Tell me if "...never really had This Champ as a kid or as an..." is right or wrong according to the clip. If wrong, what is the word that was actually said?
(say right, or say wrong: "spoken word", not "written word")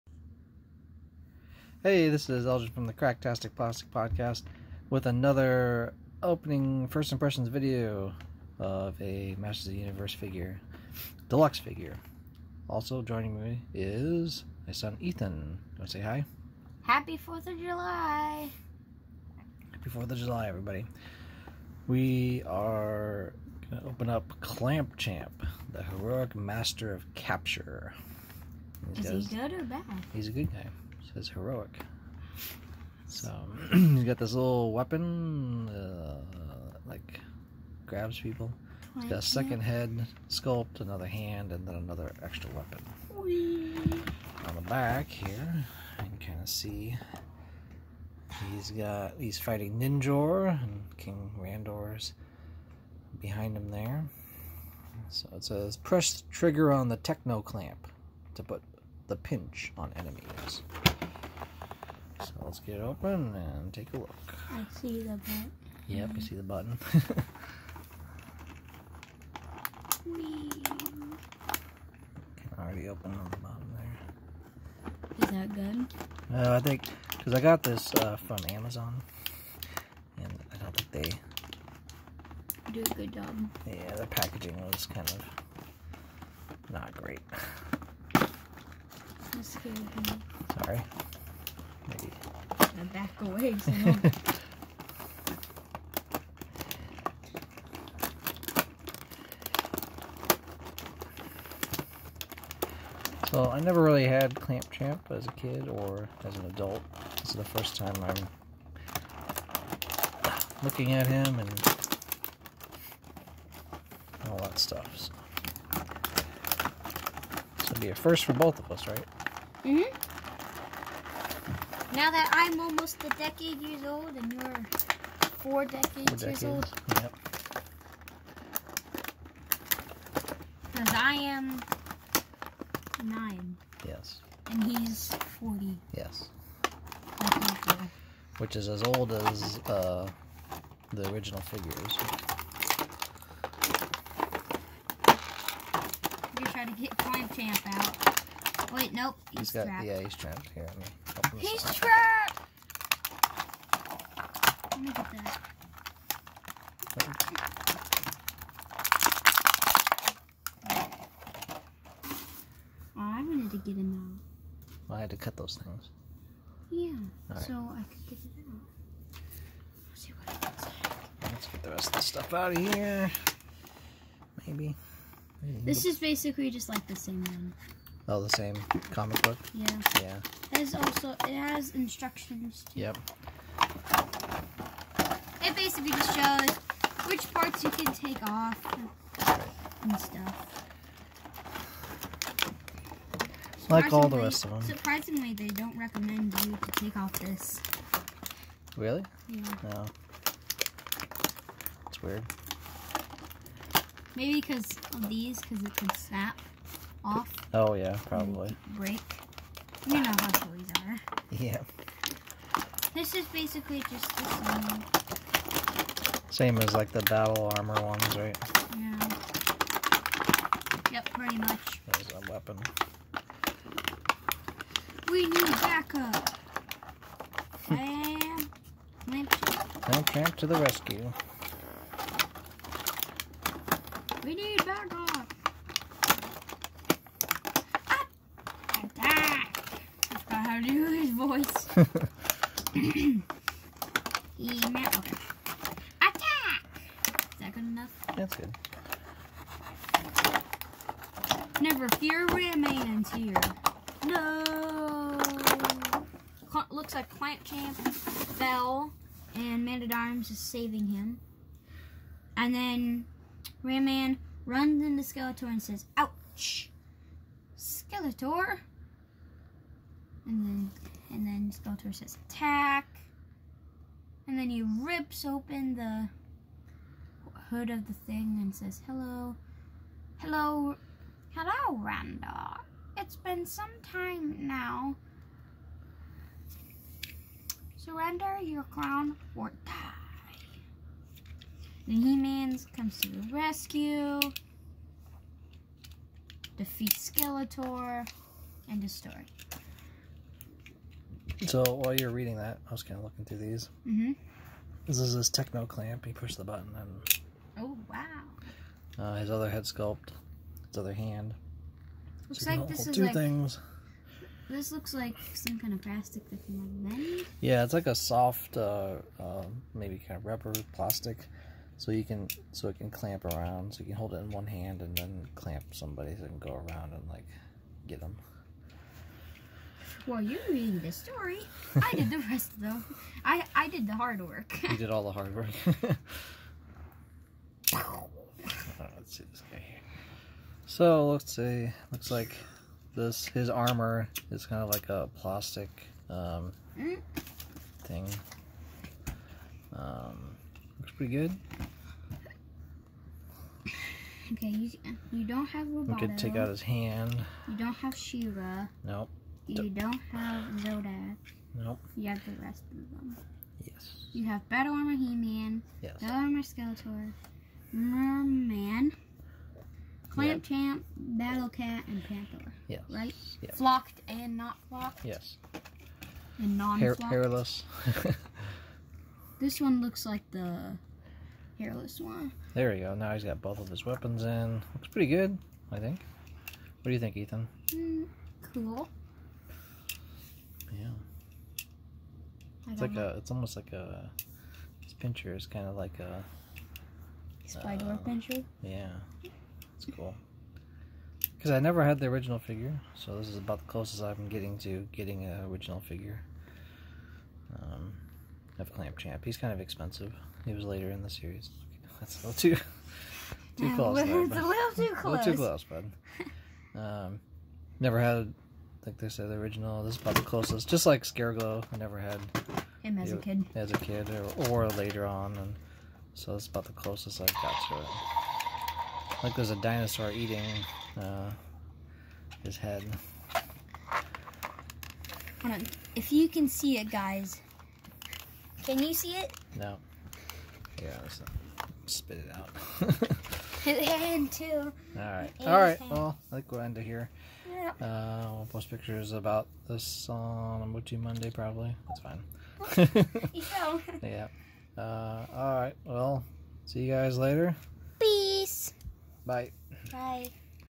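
wrong: "Clamp", not "This".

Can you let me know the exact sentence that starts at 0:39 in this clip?
He's got a second head sculpt, another hand, and then another extra weapon.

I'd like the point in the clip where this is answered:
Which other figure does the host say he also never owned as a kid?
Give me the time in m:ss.
7:01.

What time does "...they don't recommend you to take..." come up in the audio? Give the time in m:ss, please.
3:15.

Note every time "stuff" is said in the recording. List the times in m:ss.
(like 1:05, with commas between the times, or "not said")
1:54, 2:52, 3:09.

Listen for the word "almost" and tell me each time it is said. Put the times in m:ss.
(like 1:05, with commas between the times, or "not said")
2:02, 6:33.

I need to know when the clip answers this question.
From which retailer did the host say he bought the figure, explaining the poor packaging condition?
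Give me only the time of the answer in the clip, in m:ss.
1:18.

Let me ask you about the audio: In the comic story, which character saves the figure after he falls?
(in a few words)
Man at Arms.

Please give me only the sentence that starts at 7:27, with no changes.
Uh, we'll post pictures about this on MOTU Monday, probably.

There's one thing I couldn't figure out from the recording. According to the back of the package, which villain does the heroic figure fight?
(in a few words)
Ninjor.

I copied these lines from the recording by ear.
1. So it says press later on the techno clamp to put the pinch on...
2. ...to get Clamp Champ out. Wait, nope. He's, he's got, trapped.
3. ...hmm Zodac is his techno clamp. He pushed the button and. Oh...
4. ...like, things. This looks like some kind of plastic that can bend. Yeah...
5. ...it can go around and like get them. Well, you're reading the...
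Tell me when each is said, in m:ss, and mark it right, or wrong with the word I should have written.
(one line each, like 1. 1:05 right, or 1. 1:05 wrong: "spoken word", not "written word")
1. 0:55 wrong: "trigger", not "later"
2. 2:26 right
3. 5:04 wrong: "This", not "Zodac"
4. 5:13 right
5. 5:26 right.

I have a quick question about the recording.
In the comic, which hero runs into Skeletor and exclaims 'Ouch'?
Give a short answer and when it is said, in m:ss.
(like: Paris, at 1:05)
Ram Man, at 4:23.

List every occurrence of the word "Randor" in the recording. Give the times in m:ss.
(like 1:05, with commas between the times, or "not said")
0:51, 4:41.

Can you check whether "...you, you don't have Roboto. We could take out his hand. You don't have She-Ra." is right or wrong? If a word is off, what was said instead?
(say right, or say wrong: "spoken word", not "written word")
right.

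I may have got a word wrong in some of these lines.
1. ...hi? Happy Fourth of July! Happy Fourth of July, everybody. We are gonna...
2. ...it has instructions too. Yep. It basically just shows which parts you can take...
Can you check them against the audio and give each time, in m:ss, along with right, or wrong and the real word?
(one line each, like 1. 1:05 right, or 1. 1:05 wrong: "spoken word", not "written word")
1. 0:16 right
2. 3:01 right.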